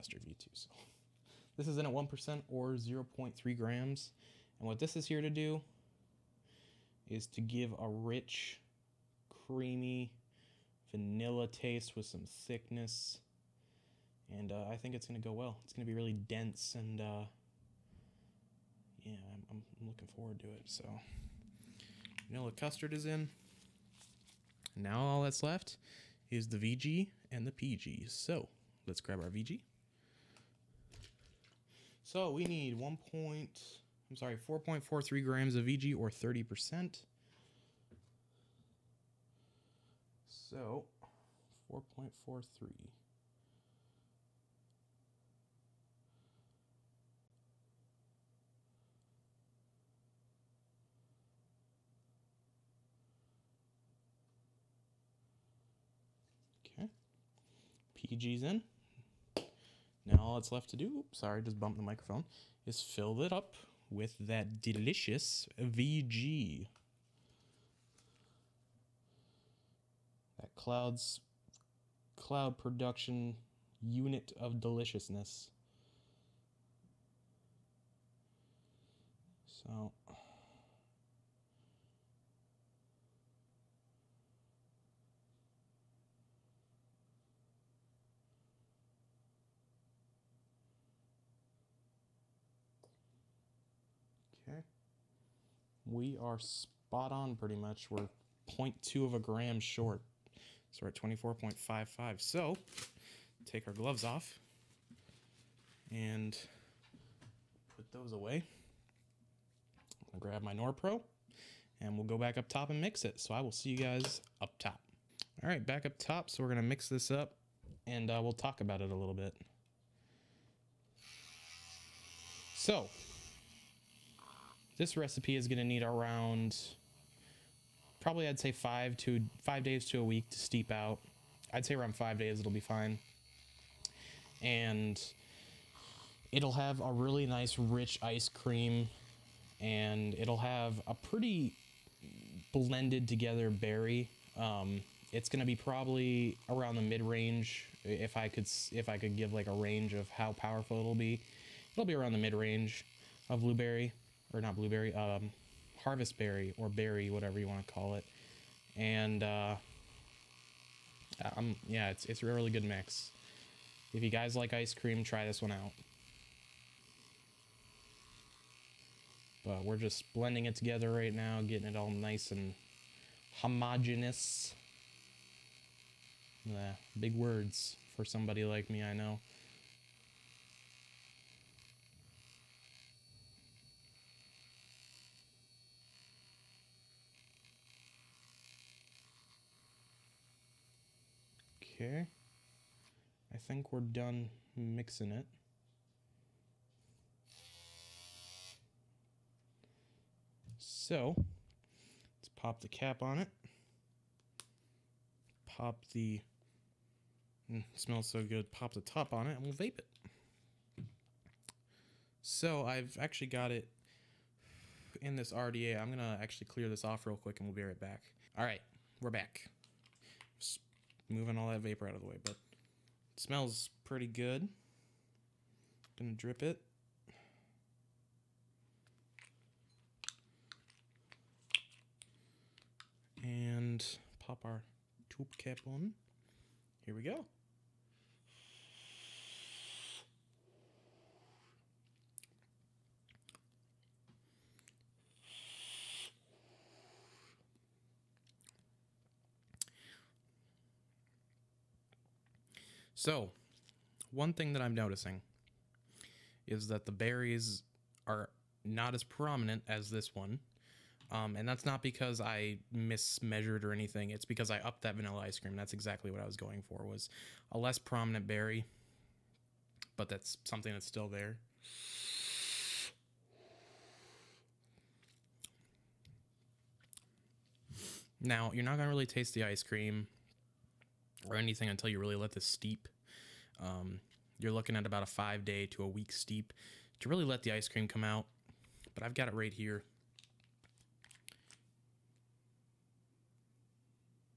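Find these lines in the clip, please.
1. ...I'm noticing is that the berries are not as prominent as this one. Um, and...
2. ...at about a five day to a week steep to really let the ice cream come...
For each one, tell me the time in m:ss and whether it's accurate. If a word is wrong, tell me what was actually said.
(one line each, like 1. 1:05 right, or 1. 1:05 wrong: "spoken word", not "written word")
1. 4:14 right
2. 4:44 right.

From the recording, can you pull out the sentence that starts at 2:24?
Um, it's going to be probably around the mid range.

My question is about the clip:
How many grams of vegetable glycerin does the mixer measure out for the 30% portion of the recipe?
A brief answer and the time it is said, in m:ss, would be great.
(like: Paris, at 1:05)
4.43 grams, at 0:34.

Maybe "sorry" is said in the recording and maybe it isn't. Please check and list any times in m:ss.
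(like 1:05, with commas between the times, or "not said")
0:34, 1:01.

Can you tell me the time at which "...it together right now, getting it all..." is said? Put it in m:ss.
2:50.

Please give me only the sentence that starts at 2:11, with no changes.
I'd say around five days it'll be fine.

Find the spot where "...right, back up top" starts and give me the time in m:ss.
1:55.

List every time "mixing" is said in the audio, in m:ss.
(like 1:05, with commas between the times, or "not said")
3:14.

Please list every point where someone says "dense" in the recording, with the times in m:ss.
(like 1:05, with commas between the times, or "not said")
0:16.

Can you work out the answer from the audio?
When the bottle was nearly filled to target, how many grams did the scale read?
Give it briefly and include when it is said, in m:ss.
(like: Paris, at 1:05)
24.55, at 1:41.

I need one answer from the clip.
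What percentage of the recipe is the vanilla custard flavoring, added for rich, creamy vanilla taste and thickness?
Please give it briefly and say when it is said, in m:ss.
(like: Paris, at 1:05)
1%, at 0:01.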